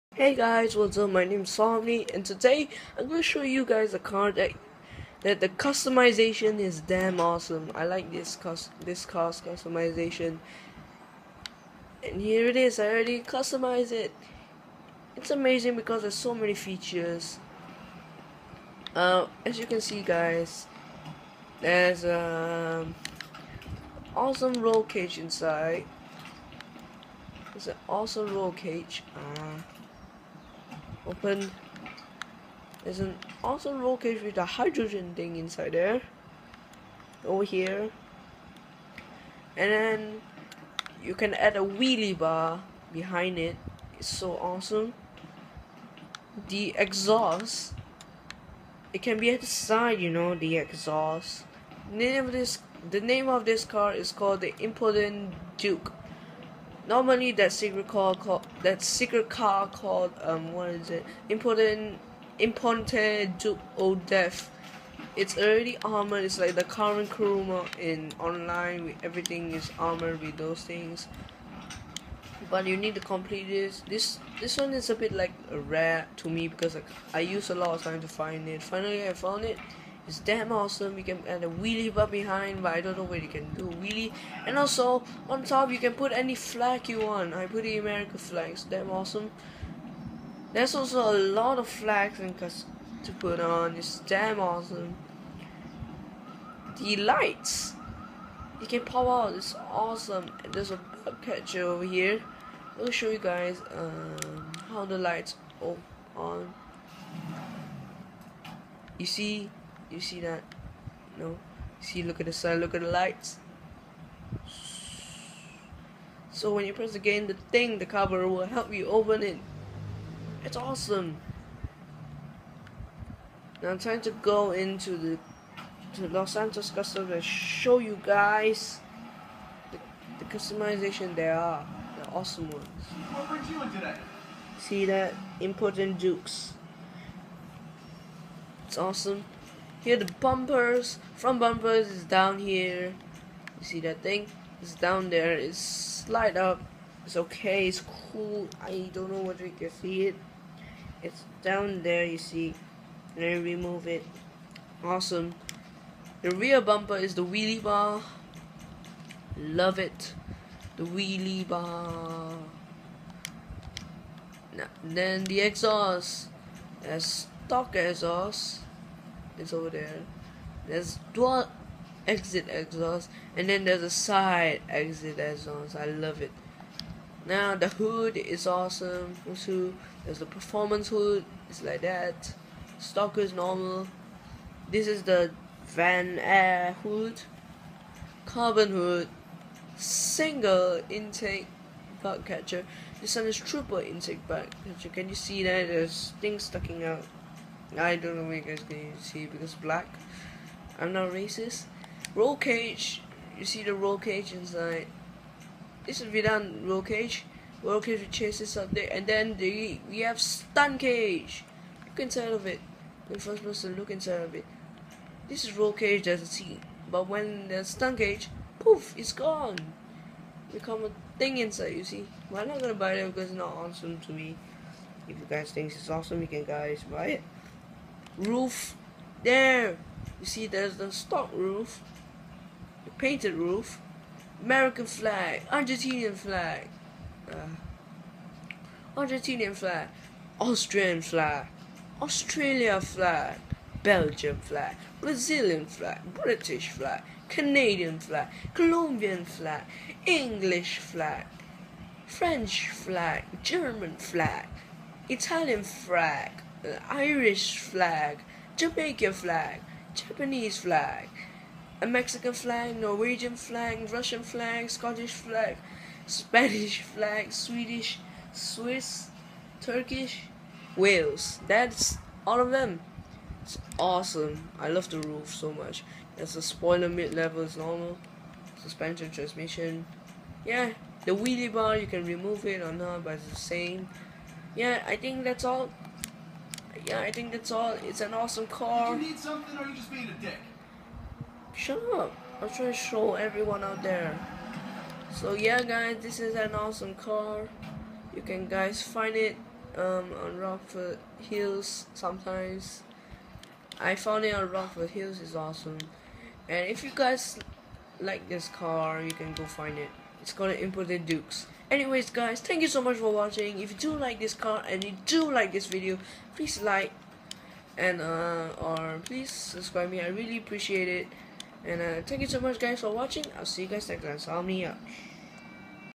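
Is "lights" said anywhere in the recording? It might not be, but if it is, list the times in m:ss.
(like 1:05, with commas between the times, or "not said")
1:36, 1:44, 1:52.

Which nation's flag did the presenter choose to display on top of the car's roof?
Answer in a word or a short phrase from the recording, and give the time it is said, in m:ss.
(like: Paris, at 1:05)
American flag, at 1:27.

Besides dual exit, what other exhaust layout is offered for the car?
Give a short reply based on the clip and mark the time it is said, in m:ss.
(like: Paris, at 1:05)
Side exit exhaust, at 2:53.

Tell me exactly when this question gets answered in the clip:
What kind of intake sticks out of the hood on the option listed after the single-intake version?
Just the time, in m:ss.
3:13.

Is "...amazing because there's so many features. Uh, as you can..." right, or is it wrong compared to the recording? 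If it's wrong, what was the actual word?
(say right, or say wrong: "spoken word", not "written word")
right.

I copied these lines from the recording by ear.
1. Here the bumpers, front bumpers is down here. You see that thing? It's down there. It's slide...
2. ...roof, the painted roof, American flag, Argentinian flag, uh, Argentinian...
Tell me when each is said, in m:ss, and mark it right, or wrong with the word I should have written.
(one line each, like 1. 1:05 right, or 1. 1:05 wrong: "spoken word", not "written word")
1. 2:19 right
2. 3:51 right.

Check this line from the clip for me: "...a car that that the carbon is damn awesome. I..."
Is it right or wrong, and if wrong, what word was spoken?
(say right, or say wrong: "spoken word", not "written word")
wrong: "customization", not "carbon".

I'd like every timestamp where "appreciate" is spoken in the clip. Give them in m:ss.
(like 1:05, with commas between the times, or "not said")
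5:20.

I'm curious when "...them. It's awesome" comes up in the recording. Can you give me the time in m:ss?
4:32.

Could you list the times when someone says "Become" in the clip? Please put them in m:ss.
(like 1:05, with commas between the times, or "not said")
3:40.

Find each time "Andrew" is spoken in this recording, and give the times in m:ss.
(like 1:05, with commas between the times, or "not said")
not said.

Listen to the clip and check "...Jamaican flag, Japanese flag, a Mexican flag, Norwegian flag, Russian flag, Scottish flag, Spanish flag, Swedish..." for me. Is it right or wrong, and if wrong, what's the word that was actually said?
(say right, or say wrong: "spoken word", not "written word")
right.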